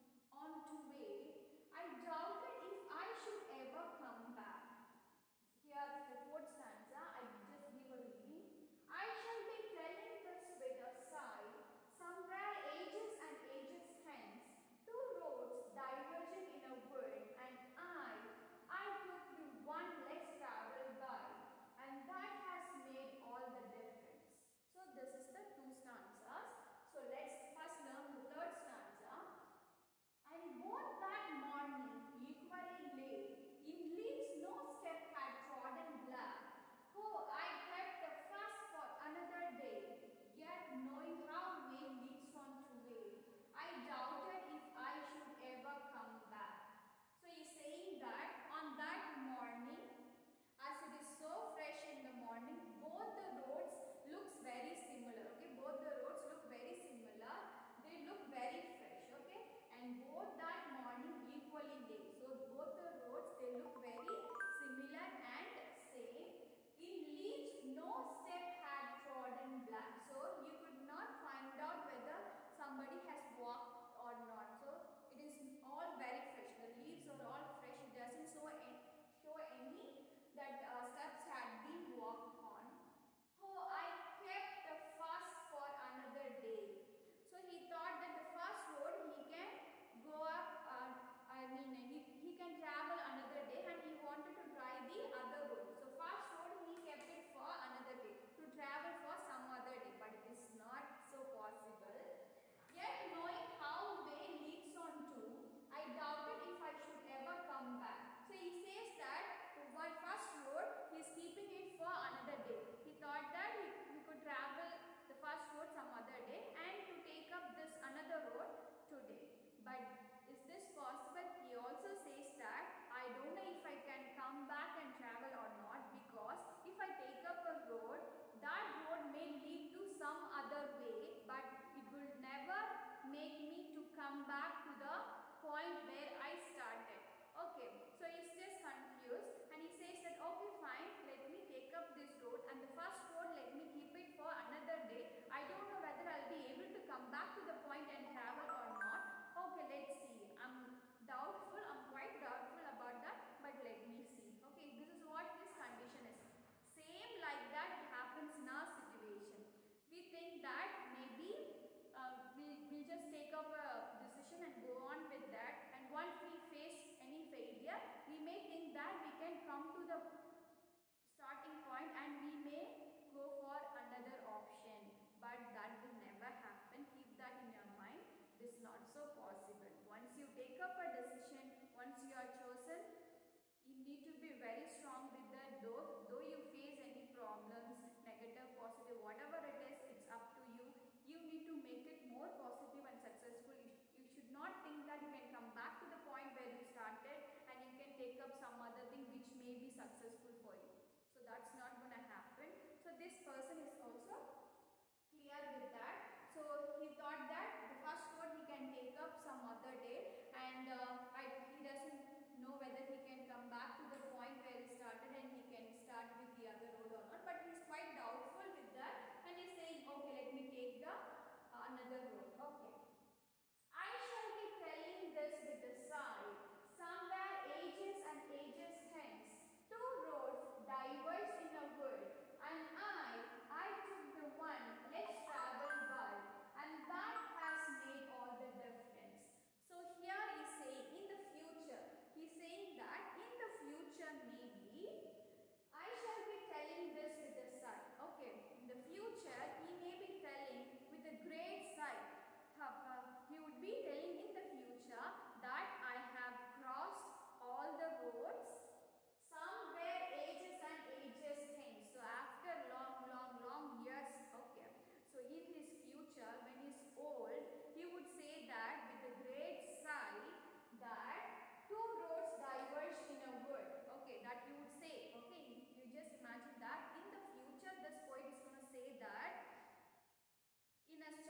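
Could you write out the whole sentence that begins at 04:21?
So after long, long, long years, okay.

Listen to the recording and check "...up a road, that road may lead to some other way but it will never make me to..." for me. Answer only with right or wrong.
right.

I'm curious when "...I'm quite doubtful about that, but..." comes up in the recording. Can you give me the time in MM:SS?
02:31.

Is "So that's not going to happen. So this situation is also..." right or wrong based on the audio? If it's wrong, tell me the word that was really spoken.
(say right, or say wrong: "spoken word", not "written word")
wrong: "person", not "situation".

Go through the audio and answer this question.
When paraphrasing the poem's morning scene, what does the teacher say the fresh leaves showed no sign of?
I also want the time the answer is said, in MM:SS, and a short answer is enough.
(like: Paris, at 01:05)
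steps, at 01:20.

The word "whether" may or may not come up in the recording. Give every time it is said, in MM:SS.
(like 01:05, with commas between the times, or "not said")
01:11, 02:25, 03:32.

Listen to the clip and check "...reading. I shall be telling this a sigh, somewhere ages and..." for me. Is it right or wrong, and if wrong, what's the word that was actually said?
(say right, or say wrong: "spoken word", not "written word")
right.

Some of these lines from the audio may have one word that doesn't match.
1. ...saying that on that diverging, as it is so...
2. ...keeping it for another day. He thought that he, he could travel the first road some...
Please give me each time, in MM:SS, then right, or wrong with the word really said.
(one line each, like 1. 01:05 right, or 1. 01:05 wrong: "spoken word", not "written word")
1. 00:47 wrong: "morning", not "diverging"
2. 01:51 right.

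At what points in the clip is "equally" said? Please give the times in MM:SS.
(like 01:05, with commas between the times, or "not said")
00:32, 01:01.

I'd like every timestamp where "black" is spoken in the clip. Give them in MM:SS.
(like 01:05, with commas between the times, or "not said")
00:36, 01:09.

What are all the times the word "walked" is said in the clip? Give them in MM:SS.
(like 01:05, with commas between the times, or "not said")
01:13, 01:21.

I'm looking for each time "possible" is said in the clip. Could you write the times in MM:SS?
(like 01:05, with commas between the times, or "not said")
01:41, 02:00, 02:59.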